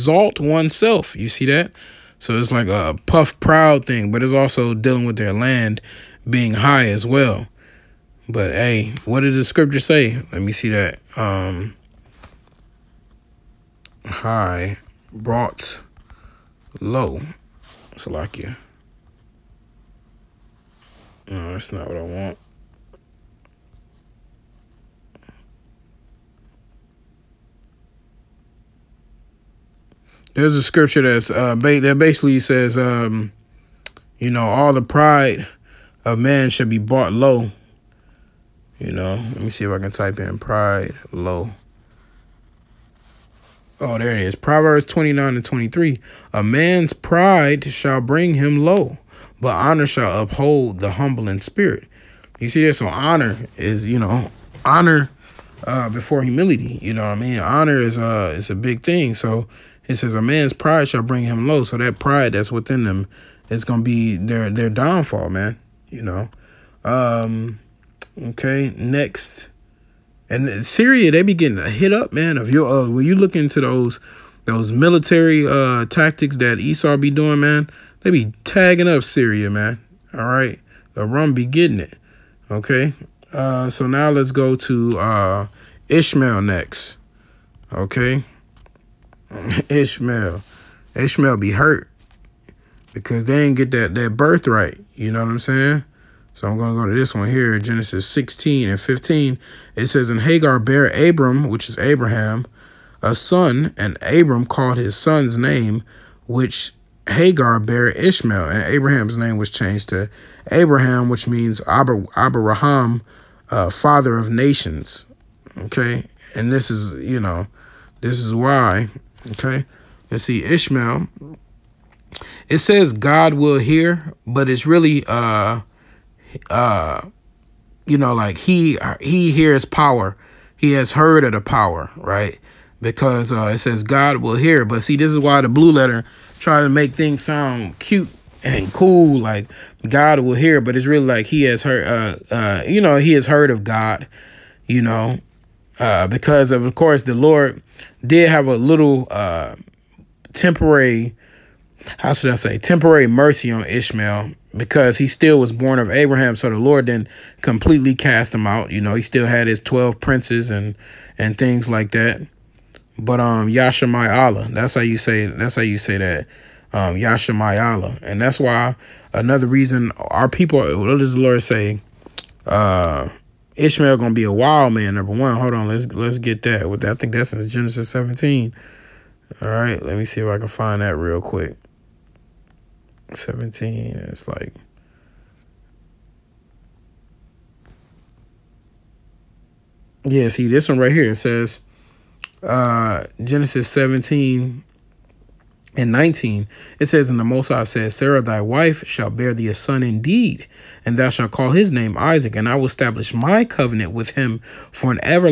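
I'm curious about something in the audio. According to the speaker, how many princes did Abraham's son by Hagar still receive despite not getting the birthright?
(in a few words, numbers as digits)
12.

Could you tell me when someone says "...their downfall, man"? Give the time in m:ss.
1:04.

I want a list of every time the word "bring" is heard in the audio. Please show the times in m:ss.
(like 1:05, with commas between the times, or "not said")
0:47, 1:01.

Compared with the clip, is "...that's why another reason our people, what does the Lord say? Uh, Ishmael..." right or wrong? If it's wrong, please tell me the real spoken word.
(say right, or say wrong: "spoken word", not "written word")
right.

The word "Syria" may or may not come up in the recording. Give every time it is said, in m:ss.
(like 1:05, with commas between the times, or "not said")
1:10, 1:19.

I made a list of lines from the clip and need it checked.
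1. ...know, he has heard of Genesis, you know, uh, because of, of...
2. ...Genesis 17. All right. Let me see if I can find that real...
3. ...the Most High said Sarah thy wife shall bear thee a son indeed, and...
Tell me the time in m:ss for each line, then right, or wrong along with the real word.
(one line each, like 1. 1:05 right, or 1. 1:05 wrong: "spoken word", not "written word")
1. 2:22 wrong: "God", not "Genesis"
2. 2:57 right
3. 3:17 right.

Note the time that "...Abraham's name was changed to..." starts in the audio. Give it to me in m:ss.
1:48.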